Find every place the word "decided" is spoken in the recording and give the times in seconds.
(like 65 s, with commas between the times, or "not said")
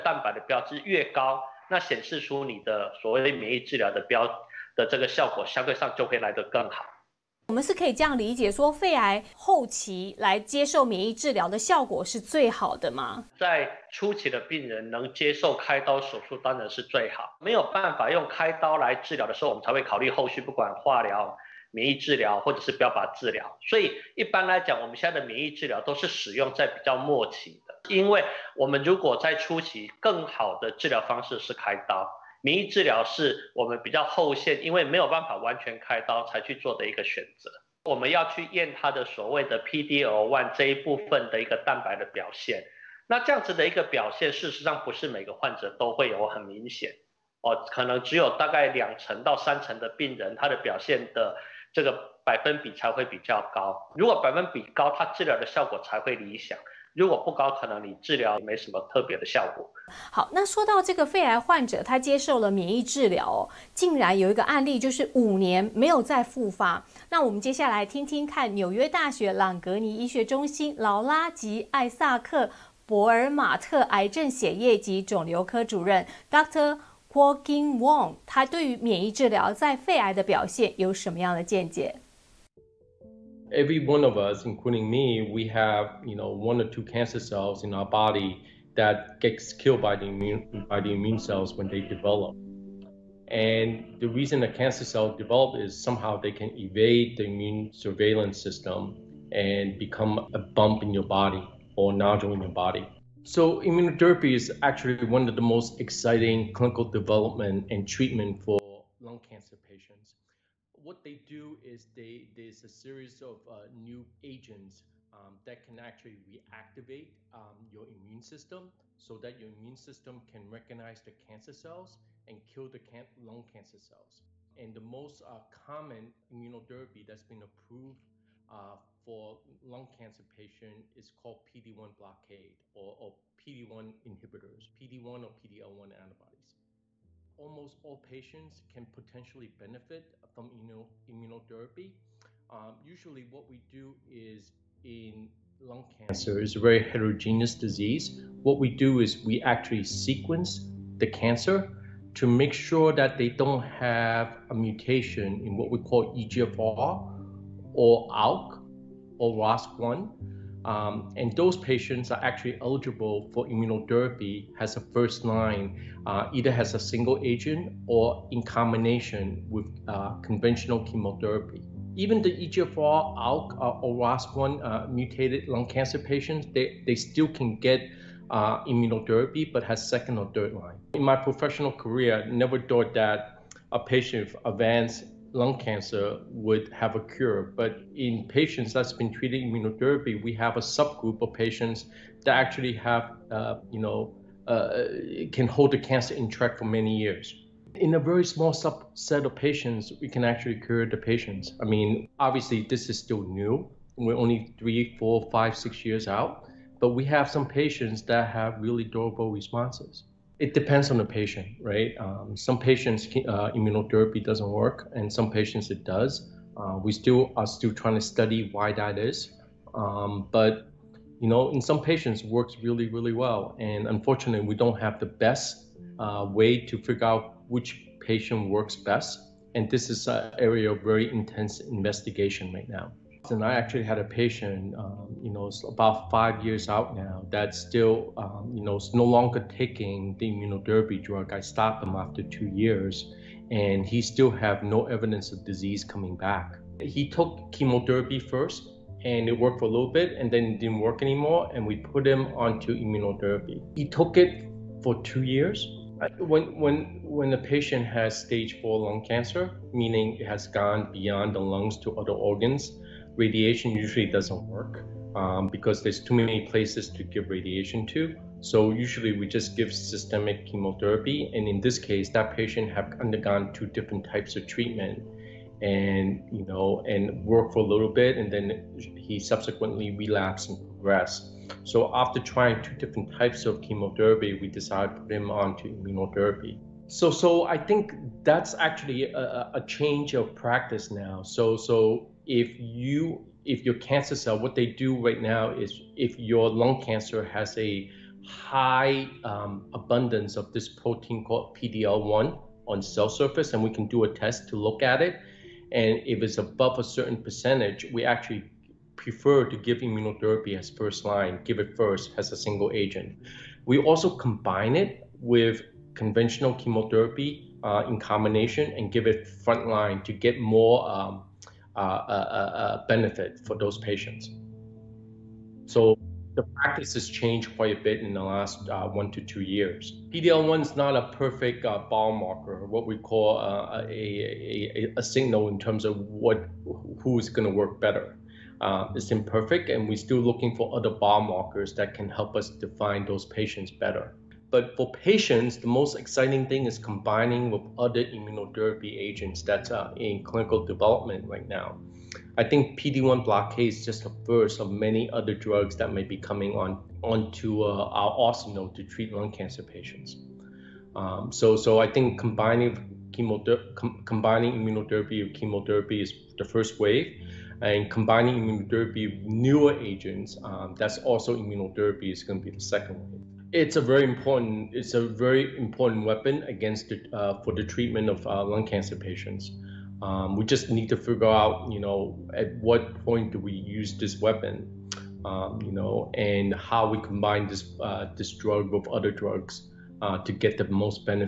284 s.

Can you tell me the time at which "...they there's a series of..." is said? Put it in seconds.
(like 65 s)
111 s.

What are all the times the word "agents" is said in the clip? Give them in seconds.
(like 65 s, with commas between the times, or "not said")
114 s, 167 s, 312 s, 349 s, 369 s.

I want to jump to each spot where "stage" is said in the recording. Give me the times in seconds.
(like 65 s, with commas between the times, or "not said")
258 s.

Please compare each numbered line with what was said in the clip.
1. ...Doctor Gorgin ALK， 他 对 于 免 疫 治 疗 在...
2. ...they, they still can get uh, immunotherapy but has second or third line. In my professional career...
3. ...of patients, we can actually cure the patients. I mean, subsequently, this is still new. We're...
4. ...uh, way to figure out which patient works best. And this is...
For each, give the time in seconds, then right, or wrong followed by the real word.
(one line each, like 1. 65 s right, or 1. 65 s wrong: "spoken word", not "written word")
1. 76 s wrong: "Wong", not "ALK"
2. 176 s right
3. 199 s wrong: "obviously", not "subsequently"
4. 226 s right.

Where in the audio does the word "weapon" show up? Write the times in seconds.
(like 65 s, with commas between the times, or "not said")
376 s, 384 s.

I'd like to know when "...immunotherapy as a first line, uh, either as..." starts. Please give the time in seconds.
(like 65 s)
163 s.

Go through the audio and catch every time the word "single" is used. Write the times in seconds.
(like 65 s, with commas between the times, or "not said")
166 s, 312 s.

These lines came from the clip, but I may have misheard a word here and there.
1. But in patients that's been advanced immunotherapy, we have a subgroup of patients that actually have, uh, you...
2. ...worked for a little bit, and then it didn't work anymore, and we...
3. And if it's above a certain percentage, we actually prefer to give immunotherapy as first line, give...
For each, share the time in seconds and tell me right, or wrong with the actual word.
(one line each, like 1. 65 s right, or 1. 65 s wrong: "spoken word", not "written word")
1. 187 s wrong: "treated", not "advanced"
2. 249 s right
3. 305 s right.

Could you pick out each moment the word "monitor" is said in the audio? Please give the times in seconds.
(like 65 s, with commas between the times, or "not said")
not said.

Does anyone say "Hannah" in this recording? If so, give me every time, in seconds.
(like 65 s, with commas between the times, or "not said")
not said.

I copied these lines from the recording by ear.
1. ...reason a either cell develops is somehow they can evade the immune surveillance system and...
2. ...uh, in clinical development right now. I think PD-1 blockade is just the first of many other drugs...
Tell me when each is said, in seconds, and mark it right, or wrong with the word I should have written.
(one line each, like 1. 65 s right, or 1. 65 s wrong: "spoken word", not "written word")
1. 94 s wrong: "cancer", not "either"
2. 349 s right.